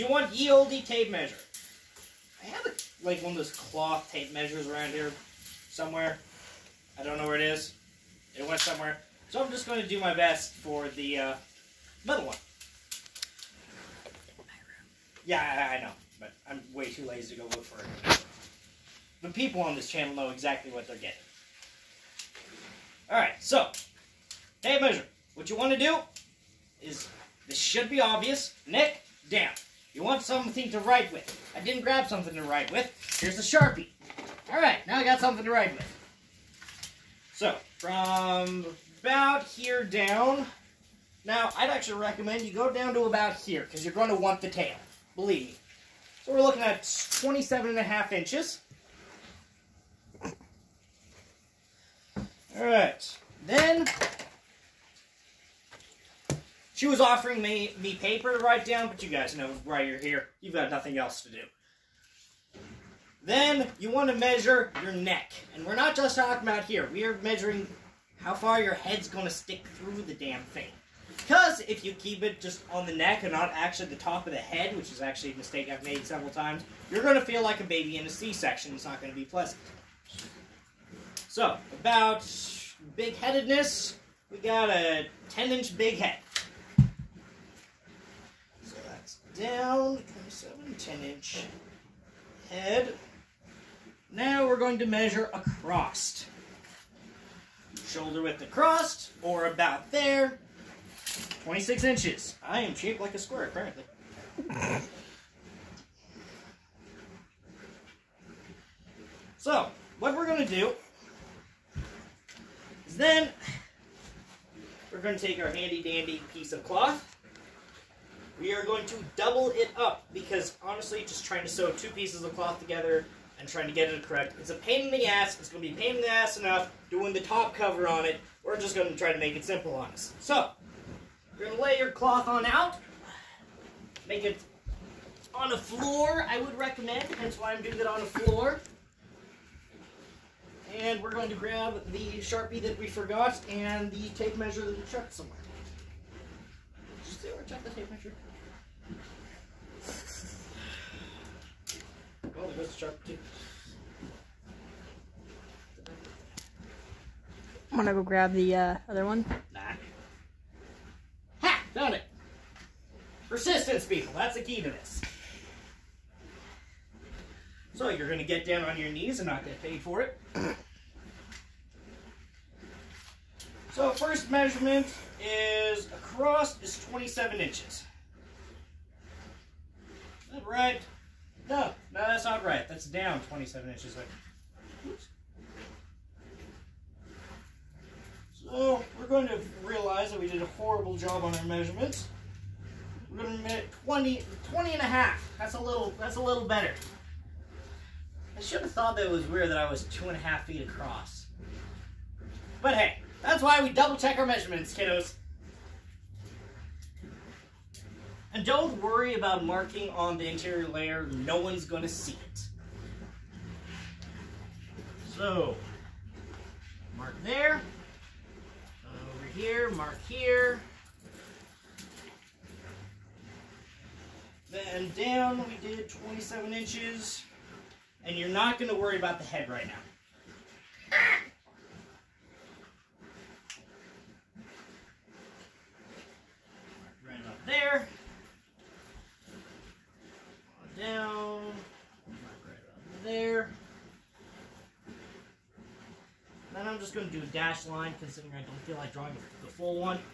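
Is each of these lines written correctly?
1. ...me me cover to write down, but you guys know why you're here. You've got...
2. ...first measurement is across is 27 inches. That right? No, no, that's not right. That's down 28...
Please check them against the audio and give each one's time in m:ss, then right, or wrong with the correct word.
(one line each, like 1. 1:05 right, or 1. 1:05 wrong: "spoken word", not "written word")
1. 0:57 wrong: "paper", not "cover"
2. 2:53 wrong: "27", not "28".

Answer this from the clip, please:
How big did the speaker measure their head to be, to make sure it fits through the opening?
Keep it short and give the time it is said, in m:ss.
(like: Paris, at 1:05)
10 inches, at 1:25.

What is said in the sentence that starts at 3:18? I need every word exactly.
I should have thought that it was weird that I was two and a half feet across.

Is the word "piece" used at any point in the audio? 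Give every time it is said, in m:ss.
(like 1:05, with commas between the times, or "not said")
1:56, 2:01.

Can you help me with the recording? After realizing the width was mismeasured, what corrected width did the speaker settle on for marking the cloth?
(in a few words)
20.5.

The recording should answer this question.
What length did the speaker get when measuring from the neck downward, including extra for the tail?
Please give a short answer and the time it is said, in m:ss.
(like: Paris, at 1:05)
27.5 inches, at 0:47.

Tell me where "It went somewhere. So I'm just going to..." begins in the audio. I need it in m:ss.
0:08.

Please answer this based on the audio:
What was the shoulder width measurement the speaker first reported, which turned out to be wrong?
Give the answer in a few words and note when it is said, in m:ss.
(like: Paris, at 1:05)
26 inches, at 1:41.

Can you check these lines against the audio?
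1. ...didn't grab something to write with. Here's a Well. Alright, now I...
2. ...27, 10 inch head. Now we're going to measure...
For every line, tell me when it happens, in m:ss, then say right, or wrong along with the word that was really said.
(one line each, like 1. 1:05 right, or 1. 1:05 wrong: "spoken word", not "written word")
1. 0:31 wrong: "Sharpie", not "Well"
2. 1:30 right.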